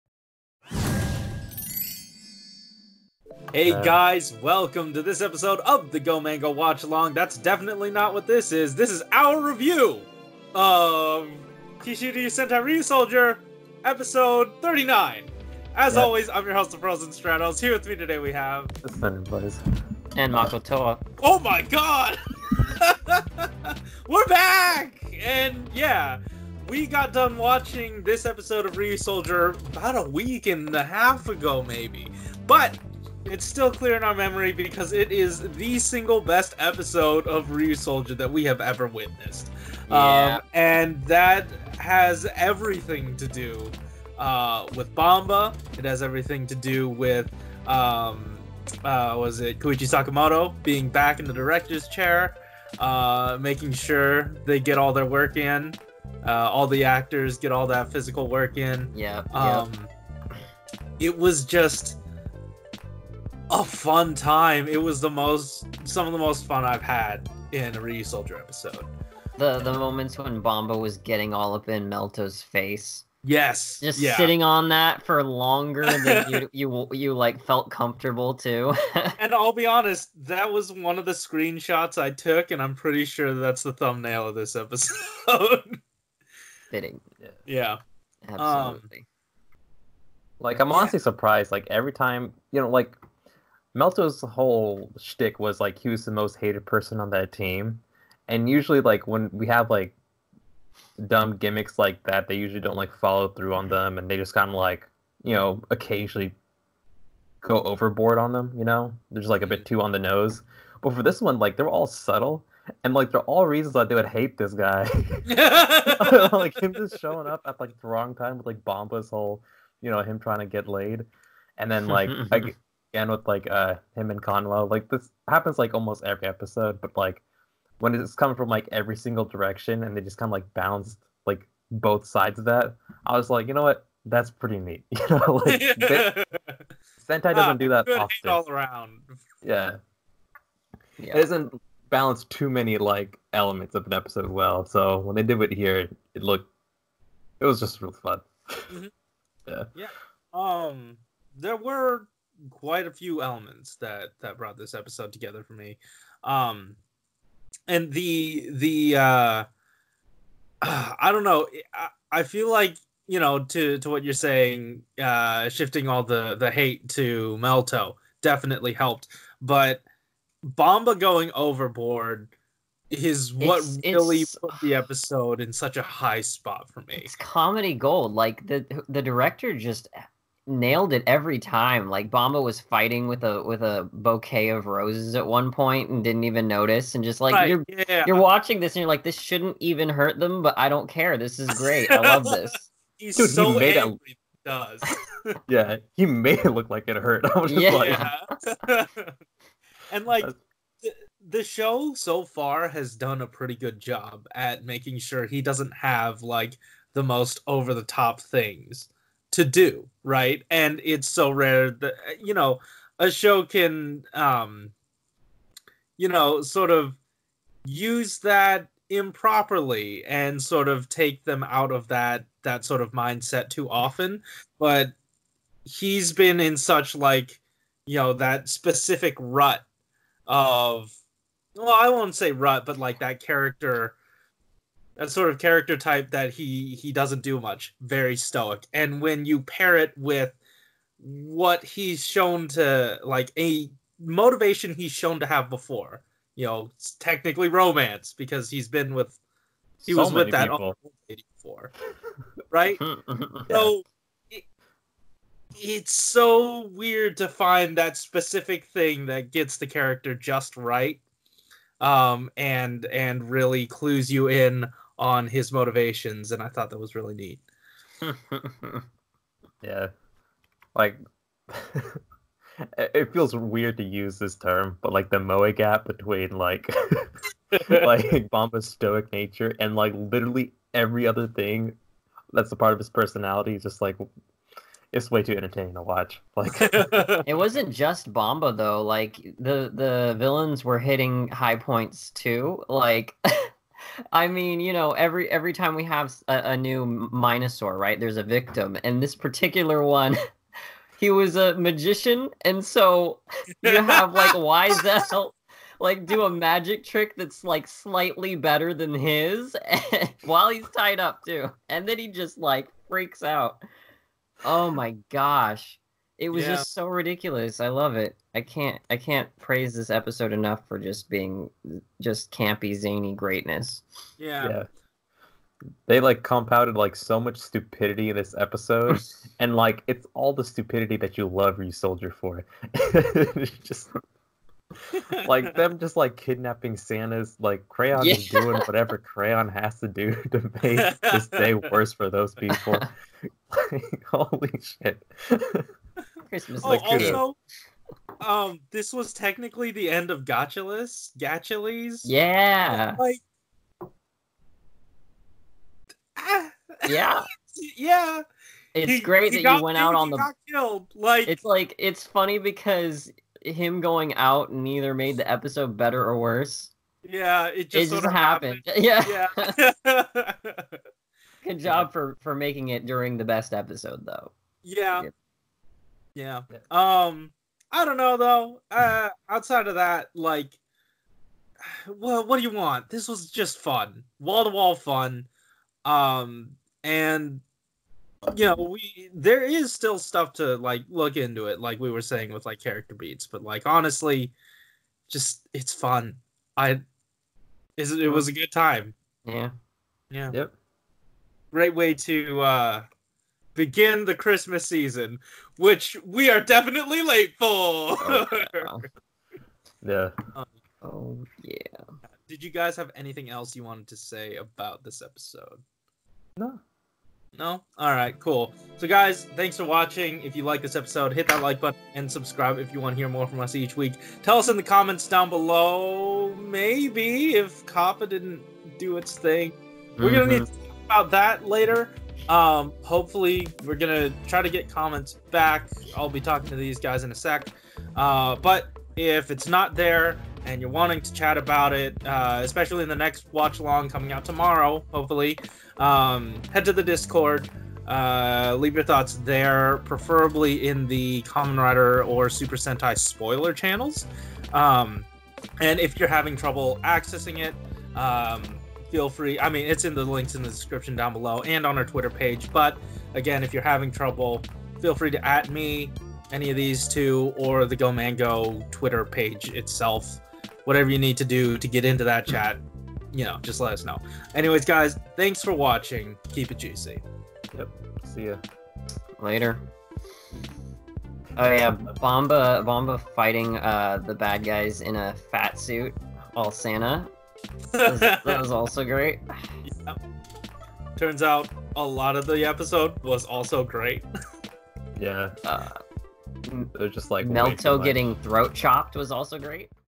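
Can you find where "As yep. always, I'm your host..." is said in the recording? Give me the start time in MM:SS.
00:15.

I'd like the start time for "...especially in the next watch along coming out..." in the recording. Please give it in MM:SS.
07:22.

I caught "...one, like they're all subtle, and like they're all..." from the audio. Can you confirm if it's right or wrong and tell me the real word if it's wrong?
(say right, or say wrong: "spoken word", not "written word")
right.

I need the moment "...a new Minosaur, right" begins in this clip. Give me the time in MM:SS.
04:56.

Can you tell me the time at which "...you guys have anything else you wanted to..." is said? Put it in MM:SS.
06:52.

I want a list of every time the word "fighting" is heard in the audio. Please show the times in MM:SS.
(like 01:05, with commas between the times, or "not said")
03:02, 08:03.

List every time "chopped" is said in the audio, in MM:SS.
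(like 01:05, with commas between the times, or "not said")
08:18.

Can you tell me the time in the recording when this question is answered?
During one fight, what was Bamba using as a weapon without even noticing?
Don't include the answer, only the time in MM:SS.
03:03.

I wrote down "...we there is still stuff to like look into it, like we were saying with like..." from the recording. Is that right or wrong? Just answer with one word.
right.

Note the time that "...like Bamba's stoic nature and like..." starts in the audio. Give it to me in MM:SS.
04:37.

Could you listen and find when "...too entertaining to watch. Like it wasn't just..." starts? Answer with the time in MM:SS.
04:45.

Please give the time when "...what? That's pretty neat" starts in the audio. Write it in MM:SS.
02:13.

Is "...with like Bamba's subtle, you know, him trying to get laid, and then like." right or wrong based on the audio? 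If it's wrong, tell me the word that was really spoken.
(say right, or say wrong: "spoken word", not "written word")
wrong: "whole", not "subtle".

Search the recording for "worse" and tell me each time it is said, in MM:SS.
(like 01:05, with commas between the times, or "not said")
05:41, 06:06.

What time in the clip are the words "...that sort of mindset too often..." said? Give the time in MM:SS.
03:42.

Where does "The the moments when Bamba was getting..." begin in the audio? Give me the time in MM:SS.
01:09.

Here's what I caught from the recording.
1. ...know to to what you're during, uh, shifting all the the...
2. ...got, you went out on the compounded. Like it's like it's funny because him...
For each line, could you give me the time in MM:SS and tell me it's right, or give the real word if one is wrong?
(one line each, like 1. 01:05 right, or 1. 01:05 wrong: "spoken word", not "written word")
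1. 02:43 wrong: "saying", not "during"
2. 05:59 wrong: "killed", not "compounded".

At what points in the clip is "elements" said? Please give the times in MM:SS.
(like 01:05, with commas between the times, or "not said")
02:23, 02:33.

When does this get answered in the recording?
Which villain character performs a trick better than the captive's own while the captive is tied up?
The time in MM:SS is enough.
05:04.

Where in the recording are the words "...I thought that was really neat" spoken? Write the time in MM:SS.
04:26.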